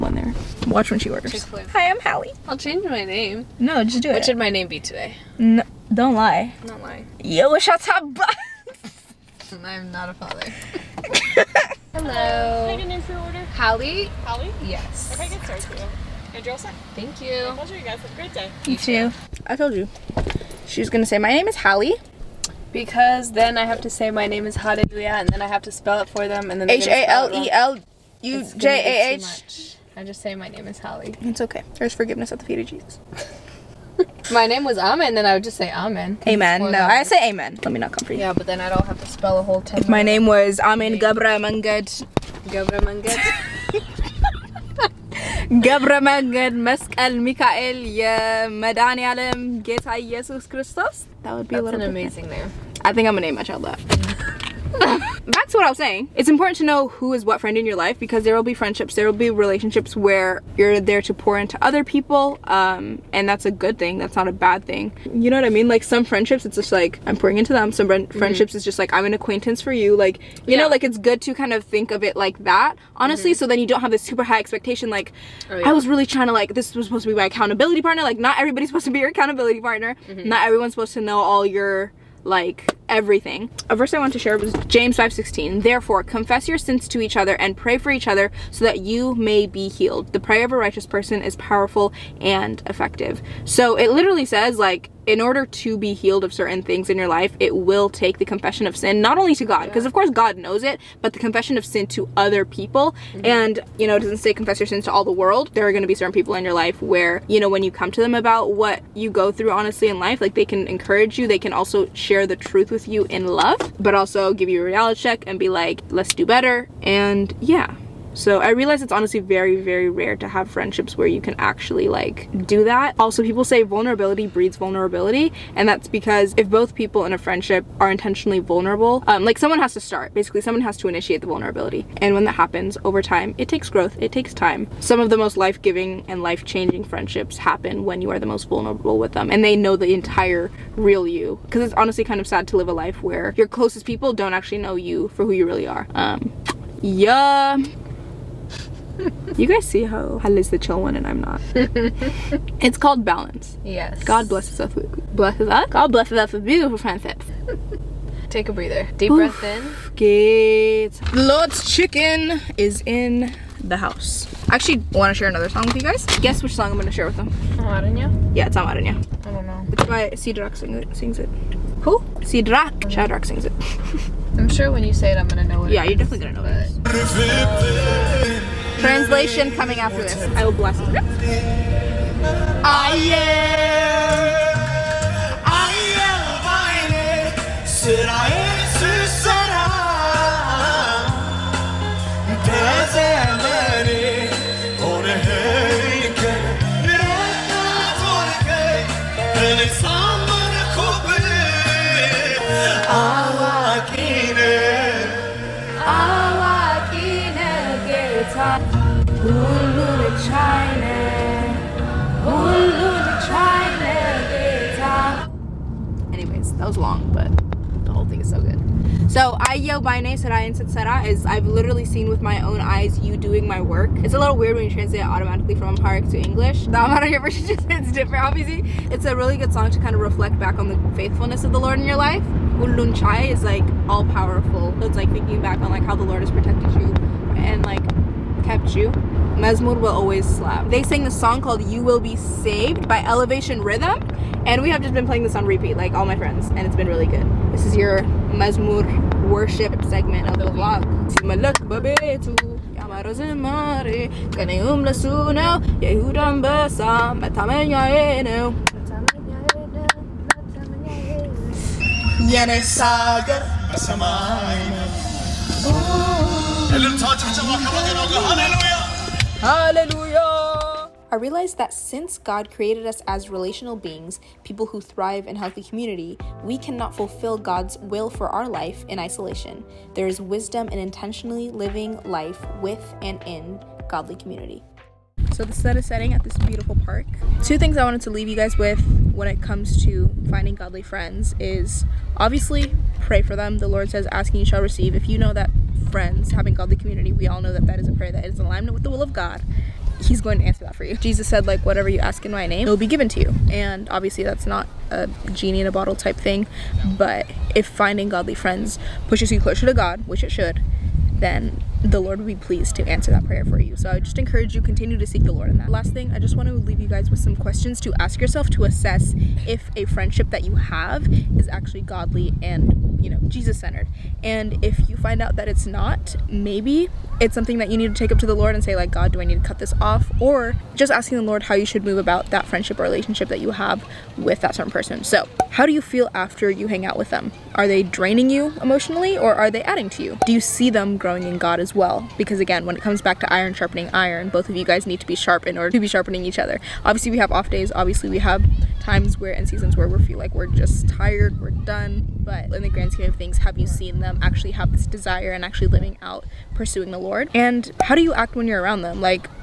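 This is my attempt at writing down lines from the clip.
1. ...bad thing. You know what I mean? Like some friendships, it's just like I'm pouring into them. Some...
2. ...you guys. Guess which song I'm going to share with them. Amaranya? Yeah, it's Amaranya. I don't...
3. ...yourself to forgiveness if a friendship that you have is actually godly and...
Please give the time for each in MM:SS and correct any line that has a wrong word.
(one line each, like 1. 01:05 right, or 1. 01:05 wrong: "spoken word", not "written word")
1. 01:04 right
2. 02:45 right
3. 05:18 wrong: "assess", not "forgiveness".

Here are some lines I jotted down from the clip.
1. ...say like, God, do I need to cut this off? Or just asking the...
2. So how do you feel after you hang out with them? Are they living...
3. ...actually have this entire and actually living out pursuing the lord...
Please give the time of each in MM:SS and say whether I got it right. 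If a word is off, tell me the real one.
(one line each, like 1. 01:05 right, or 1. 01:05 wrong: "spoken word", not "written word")
1. 05:28 right
2. 05:35 wrong: "draining", not "living"
3. 05:54 wrong: "desire", not "entire".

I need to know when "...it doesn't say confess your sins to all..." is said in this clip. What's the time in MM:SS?
01:43.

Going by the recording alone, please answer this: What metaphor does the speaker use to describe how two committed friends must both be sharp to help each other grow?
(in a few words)
Iron sharpening iron.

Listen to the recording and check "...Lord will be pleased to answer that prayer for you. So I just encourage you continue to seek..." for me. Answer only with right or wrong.
right.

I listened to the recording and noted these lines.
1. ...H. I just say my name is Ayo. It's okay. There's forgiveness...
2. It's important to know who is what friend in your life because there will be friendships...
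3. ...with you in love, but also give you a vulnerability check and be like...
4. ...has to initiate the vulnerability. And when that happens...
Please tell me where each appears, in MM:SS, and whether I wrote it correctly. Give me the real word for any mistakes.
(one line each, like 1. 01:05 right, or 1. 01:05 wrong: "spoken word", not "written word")
1. 00:29 wrong: "Holly", not "Ayo"
2. 00:56 right
3. 01:52 wrong: "reality", not "vulnerability"
4. 02:10 right.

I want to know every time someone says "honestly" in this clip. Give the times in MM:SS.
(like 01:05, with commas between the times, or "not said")
01:12, 01:49, 01:58, 02:21.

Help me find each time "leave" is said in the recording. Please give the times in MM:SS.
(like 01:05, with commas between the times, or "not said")
04:48, 05:16.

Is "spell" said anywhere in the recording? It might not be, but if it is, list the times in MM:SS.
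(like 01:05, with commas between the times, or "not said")
00:25, 00:39.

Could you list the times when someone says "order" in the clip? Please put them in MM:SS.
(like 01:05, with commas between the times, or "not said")
00:01, 00:13, 01:35, 05:45.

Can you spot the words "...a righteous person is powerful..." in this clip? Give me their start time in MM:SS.
01:30.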